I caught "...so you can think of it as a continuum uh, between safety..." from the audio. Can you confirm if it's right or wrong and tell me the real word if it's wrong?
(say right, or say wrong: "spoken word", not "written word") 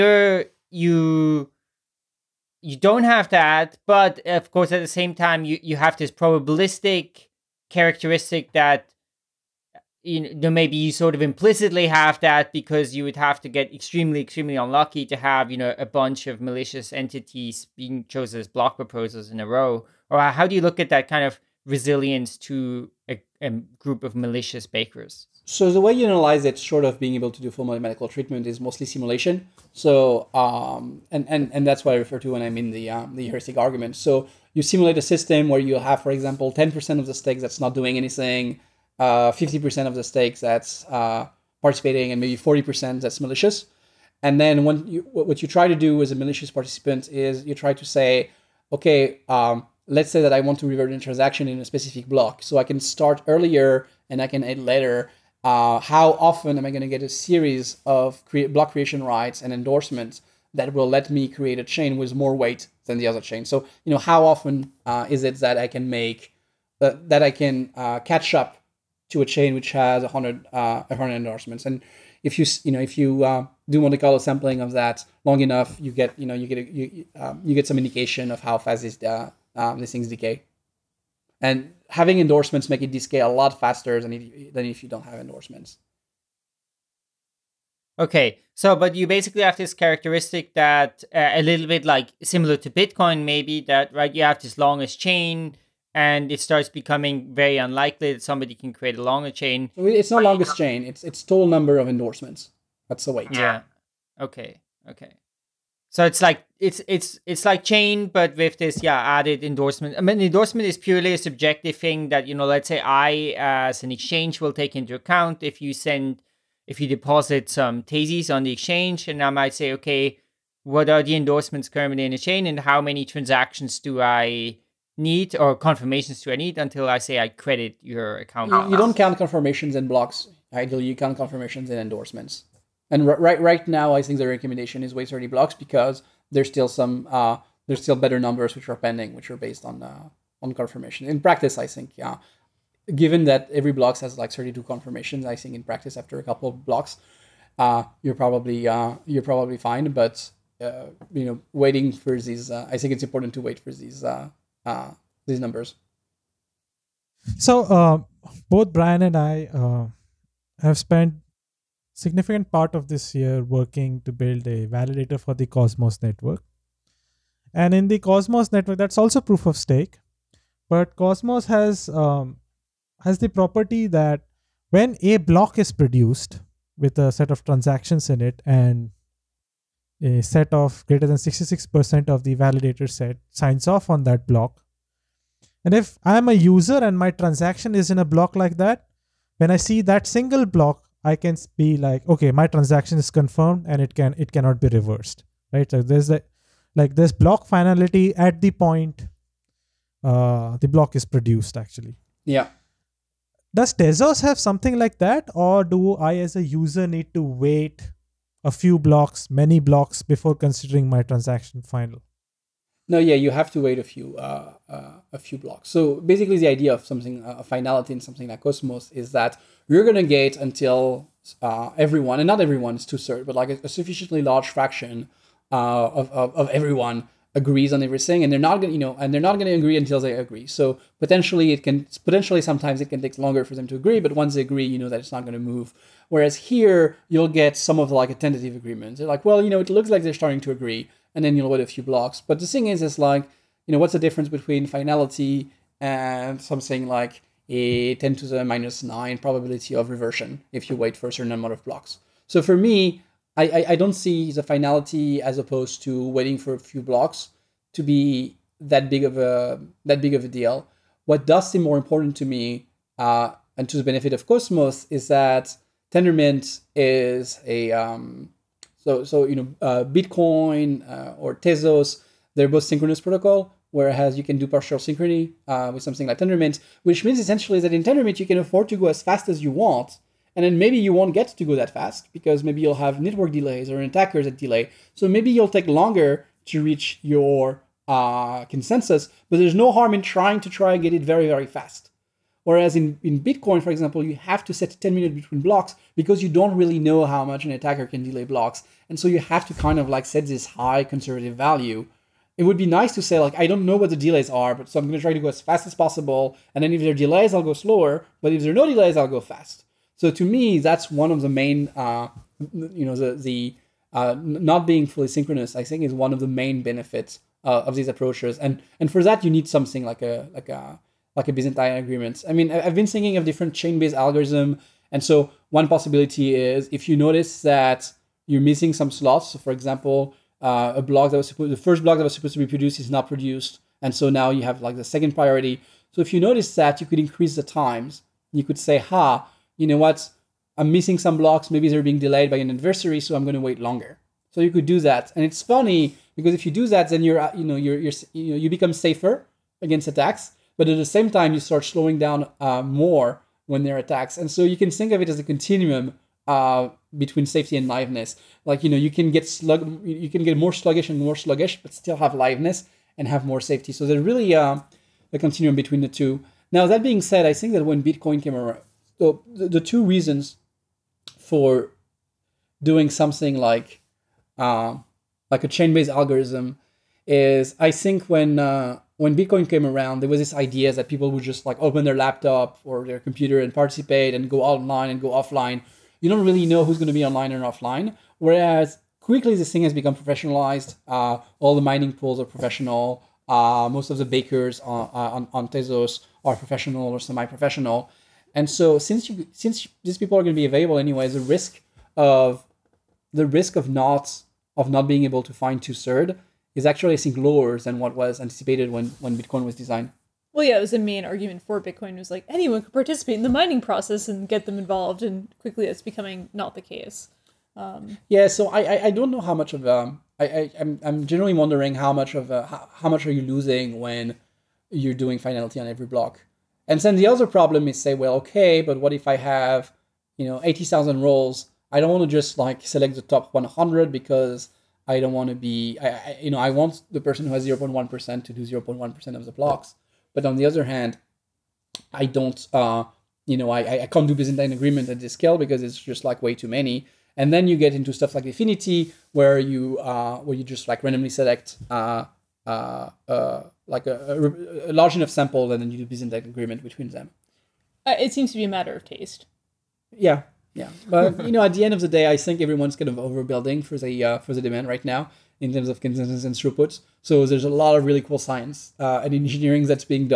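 right.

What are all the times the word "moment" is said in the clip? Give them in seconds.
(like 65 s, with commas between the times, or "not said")
not said.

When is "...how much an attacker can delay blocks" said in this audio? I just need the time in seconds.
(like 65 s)
297 s.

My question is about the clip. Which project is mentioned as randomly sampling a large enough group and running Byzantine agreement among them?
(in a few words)
DFINITY.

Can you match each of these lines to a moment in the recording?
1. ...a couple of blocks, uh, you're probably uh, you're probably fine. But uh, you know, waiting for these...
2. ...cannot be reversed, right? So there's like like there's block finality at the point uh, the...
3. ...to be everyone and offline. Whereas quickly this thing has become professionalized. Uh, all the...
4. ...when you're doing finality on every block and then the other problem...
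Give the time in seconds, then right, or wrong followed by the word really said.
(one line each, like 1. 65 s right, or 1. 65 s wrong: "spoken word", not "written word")
1. 146 s right
2. 194 s right
3. 386 s wrong: "online", not "everyone"
4. 423 s right.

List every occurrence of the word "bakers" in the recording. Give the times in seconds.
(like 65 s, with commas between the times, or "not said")
24 s, 394 s.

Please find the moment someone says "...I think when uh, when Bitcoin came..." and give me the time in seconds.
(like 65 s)
377 s.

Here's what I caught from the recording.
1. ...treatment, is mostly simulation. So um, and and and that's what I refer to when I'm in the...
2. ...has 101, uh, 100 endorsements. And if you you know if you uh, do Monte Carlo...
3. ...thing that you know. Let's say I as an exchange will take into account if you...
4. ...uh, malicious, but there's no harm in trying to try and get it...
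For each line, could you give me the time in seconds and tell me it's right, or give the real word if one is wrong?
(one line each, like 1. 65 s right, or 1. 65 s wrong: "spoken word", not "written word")
1. 28 s right
2. 69 s wrong: "100", not "101"
3. 111 s right
4. 287 s wrong: "consensus", not "malicious".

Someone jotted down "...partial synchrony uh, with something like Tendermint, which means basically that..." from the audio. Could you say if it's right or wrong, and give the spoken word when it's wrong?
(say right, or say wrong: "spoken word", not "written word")
wrong: "essentially", not "basically".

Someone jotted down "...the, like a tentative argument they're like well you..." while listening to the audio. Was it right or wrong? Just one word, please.
wrong.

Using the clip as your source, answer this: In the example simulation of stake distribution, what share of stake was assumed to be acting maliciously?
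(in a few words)
40%.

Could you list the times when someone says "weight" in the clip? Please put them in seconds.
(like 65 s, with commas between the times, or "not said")
62 s, 103 s.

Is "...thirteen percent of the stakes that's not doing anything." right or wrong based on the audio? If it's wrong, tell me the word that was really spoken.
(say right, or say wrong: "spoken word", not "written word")
wrong: "ten", not "thirteen".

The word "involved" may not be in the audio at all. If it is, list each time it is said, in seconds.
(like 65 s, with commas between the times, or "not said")
414 s.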